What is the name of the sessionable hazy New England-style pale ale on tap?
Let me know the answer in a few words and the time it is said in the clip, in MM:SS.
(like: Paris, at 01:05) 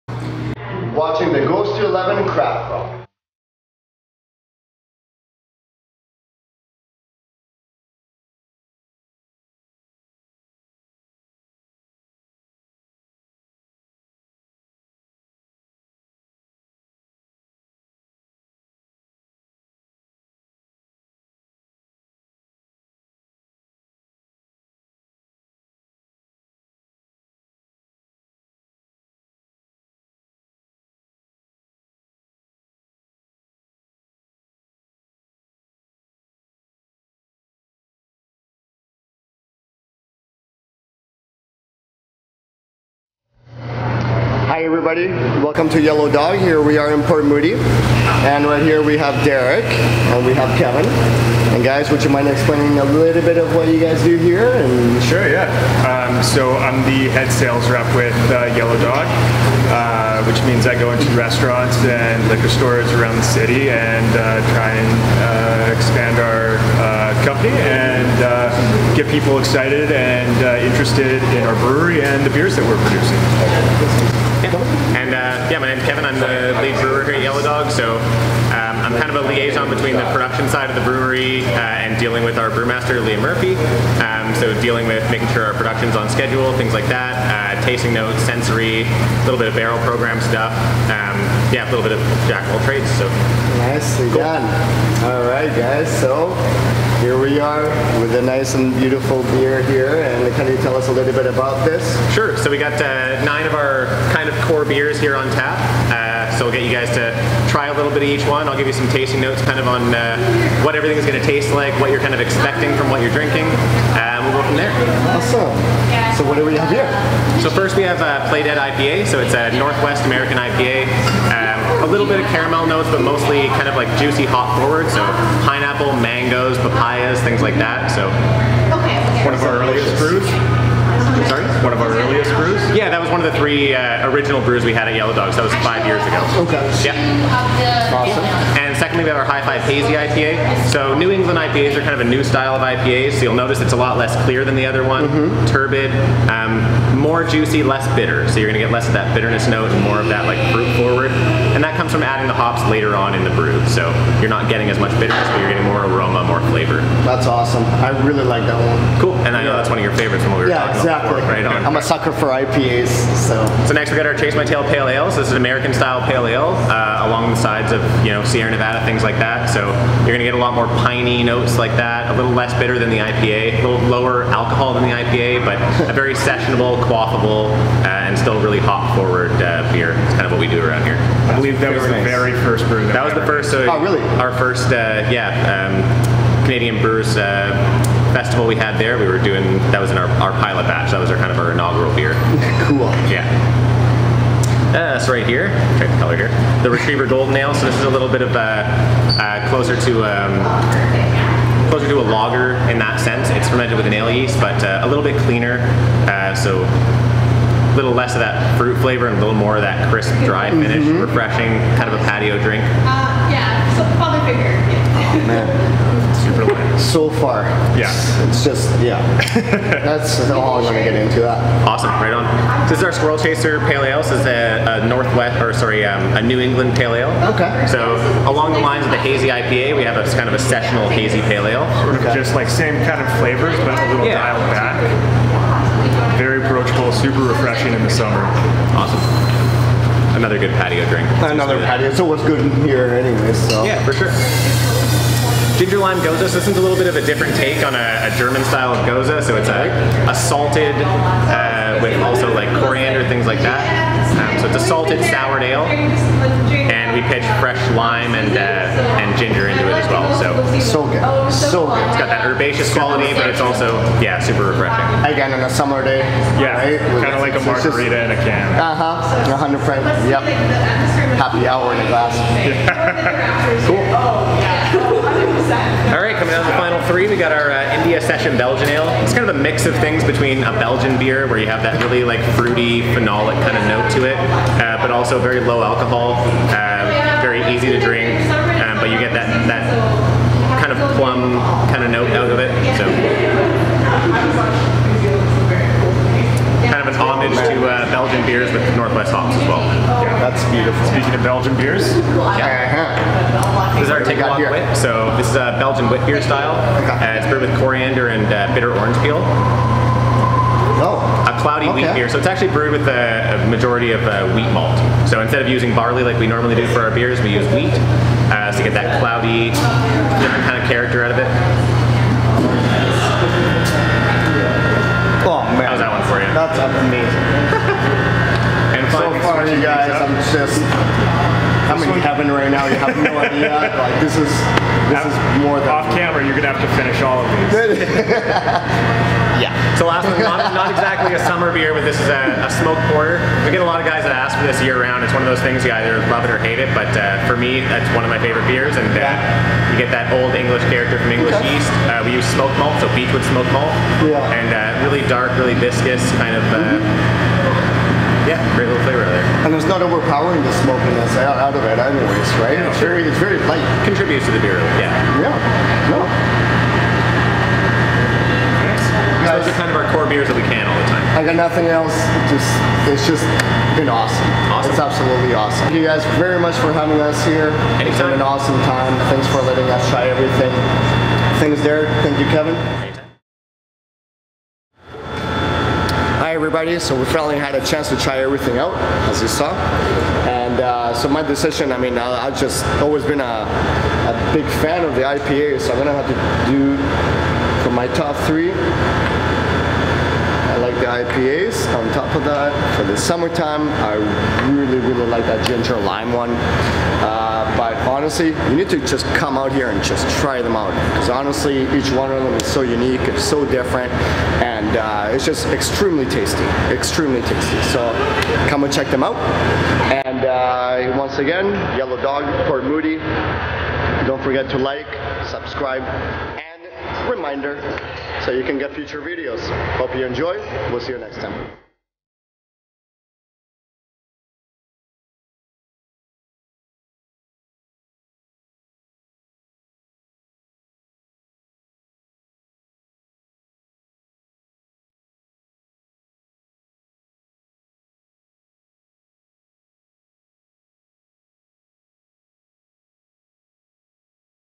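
Squirrel Chaser Pale Ale, at 03:42.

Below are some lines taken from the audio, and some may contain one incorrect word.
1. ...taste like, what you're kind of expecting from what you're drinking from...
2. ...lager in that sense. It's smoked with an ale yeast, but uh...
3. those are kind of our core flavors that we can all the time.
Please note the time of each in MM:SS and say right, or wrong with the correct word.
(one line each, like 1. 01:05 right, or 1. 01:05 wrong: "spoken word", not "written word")
1. 01:51 right
2. 03:22 wrong: "fermented", not "smoked"
3. 06:09 wrong: "beers", not "flavors".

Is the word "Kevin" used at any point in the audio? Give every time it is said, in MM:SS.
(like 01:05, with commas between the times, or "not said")
00:50, 01:15, 06:22.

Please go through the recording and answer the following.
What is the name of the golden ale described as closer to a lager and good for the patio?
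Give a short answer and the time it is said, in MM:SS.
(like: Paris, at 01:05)
Retriever Golden Ale, at 03:16.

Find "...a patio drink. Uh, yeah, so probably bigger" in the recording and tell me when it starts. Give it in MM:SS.
03:31.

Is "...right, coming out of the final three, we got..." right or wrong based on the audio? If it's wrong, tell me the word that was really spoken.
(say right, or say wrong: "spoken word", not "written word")
right.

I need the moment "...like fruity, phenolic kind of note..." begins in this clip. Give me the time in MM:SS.
04:42.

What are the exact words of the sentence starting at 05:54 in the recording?
and uh, really dark, really viscous kind of.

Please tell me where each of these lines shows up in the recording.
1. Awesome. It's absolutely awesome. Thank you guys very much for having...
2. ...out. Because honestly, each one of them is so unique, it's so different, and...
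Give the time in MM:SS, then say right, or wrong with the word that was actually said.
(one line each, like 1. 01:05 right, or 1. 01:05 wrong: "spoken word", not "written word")
1. 06:14 right
2. 06:50 right.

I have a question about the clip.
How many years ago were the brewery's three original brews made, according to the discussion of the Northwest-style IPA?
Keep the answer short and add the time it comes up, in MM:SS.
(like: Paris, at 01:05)
5, at 02:15.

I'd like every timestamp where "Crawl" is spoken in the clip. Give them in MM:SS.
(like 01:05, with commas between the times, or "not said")
00:02.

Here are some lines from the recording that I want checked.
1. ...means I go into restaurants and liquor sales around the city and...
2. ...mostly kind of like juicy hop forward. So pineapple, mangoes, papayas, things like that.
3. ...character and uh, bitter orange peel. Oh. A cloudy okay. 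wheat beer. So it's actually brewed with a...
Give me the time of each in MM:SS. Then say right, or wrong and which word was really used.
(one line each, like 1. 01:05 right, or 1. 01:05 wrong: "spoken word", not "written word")
1. 01:00 wrong: "stores", not "sales"
2. 02:03 right
3. 05:07 wrong: "coriander", not "character".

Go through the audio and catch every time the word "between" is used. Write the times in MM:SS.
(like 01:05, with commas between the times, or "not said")
01:19, 04:40.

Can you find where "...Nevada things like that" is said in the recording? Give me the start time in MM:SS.
02:48.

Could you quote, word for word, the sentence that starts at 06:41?
On top of that, for the summertime, I really, really like that ginger lime one.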